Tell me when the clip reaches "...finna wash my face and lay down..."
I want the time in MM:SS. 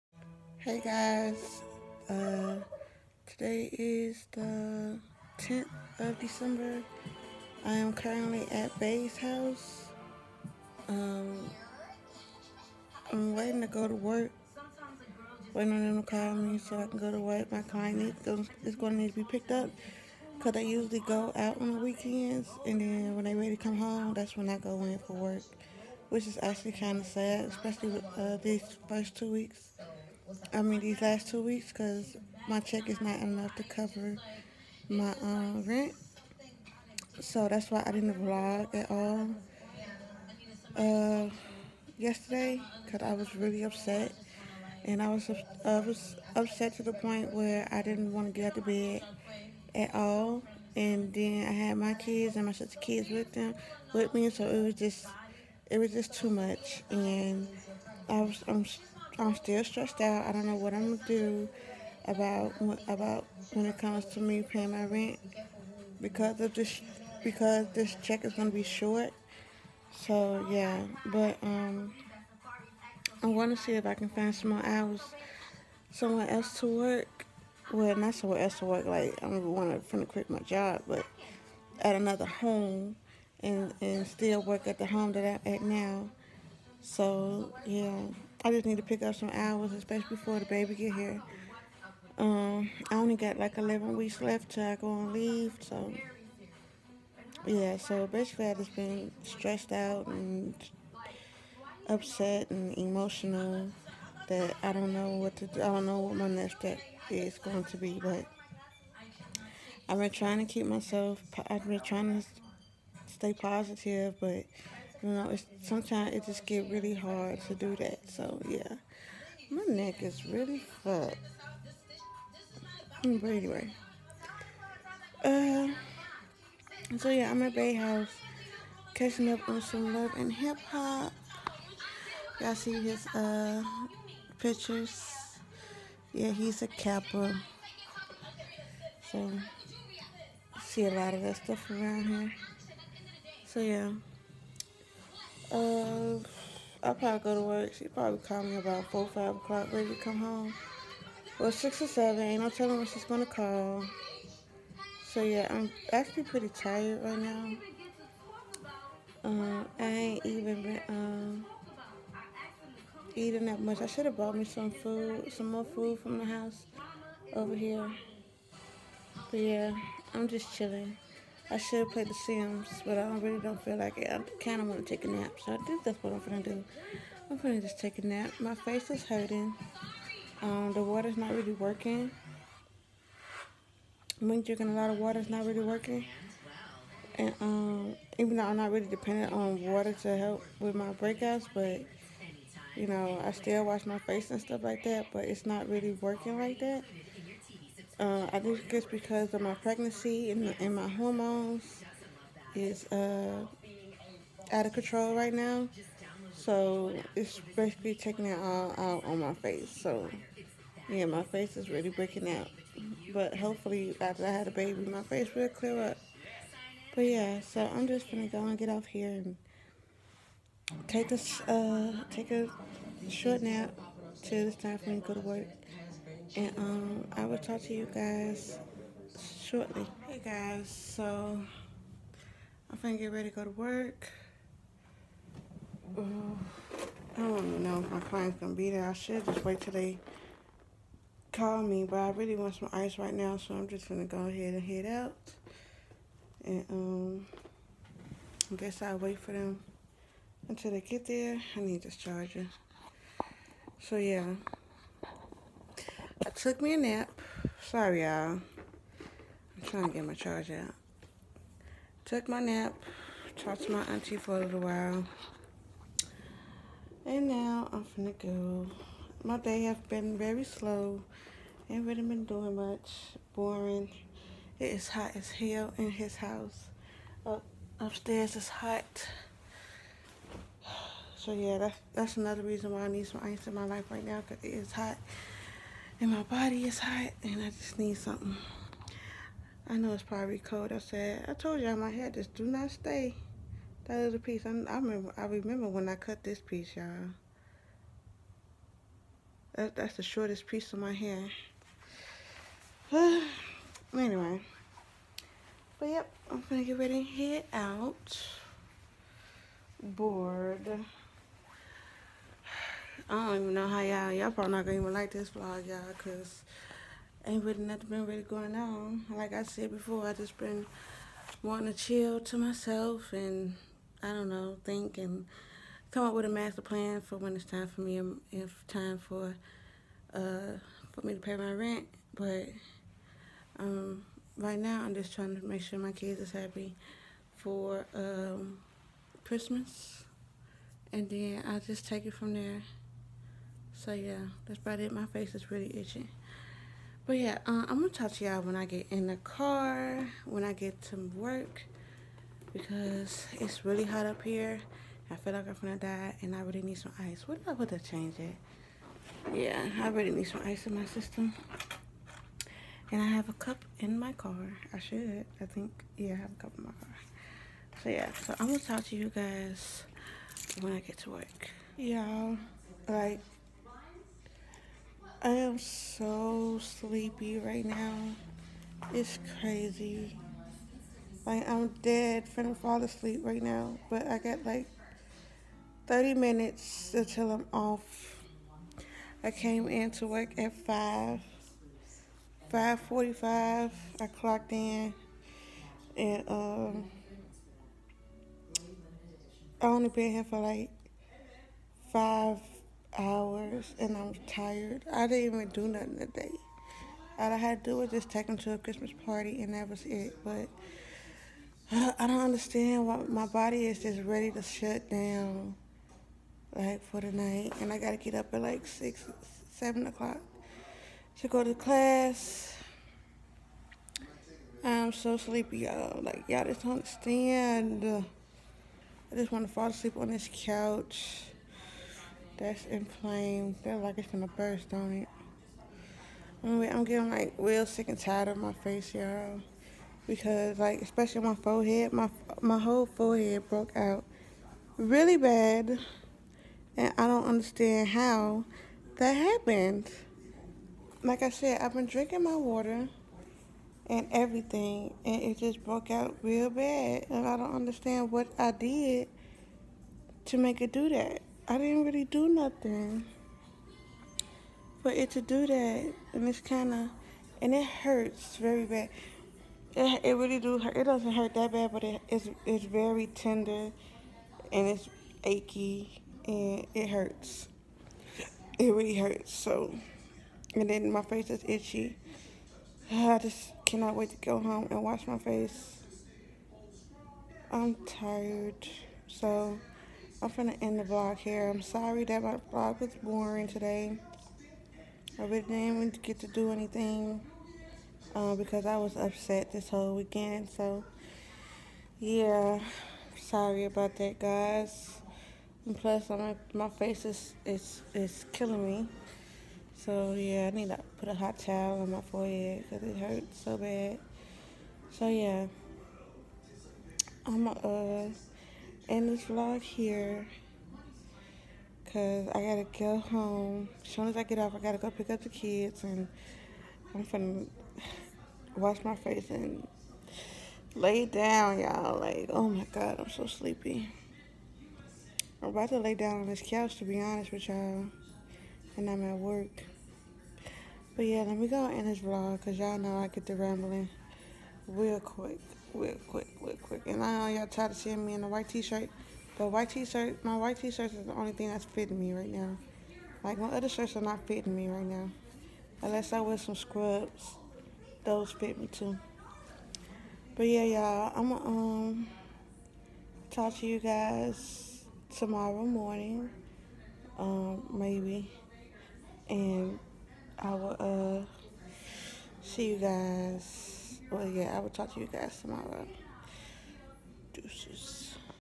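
08:47.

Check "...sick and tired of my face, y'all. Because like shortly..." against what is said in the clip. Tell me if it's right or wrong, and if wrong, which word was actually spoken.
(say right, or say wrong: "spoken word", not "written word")
wrong: "especially", not "shortly".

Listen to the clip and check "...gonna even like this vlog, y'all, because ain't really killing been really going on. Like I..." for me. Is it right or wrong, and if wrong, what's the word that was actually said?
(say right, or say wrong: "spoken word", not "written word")
wrong: "nothing", not "killing".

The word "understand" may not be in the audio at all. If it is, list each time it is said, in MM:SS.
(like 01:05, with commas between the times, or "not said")
06:52, 07:06, 07:27, 07:37.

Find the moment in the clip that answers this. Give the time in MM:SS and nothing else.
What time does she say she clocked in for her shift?
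06:32.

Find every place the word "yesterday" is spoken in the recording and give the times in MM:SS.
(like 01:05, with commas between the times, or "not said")
00:41.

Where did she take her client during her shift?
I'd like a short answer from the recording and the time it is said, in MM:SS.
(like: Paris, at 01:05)
A Christmas party, at 06:48.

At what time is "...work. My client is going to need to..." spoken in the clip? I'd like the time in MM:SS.
00:17.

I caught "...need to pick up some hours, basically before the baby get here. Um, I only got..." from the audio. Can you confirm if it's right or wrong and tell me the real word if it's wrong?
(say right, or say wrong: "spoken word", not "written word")
wrong: "especially", not "basically".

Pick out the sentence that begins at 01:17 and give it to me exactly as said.
Well, not somewhere else to work.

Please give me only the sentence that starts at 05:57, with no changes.
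What did I gonna change it?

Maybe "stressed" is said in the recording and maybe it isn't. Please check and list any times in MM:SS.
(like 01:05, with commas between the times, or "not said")
00:59, 01:39.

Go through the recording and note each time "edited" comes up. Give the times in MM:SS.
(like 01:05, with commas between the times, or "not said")
not said.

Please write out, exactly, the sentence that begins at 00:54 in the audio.
So it was just, it was just too much.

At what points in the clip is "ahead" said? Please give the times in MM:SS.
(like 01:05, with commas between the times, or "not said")
04:04.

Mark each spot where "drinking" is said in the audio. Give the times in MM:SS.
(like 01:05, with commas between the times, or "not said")
03:04, 07:31.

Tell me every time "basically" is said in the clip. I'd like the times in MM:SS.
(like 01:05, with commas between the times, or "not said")
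01:38, 03:27.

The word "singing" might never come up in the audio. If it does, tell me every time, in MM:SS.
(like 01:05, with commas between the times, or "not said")
not said.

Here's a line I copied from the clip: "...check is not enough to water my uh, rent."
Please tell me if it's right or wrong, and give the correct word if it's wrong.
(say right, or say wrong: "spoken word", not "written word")
wrong: "cover", not "water".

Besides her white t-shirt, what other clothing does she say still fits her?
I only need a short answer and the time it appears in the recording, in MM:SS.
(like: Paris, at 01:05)
Scrubs, at 09:16.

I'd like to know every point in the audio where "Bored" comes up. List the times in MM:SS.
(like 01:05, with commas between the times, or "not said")
05:09.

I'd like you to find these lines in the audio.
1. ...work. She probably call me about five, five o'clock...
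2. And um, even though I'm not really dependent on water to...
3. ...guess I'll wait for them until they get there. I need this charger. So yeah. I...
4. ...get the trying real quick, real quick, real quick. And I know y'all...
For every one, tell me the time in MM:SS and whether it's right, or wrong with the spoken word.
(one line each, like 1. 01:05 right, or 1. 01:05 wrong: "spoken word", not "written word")
1. 02:27 wrong: "four", not "five"
2. 03:07 right
3. 04:08 right
4. 09:03 wrong: "rambling", not "trying".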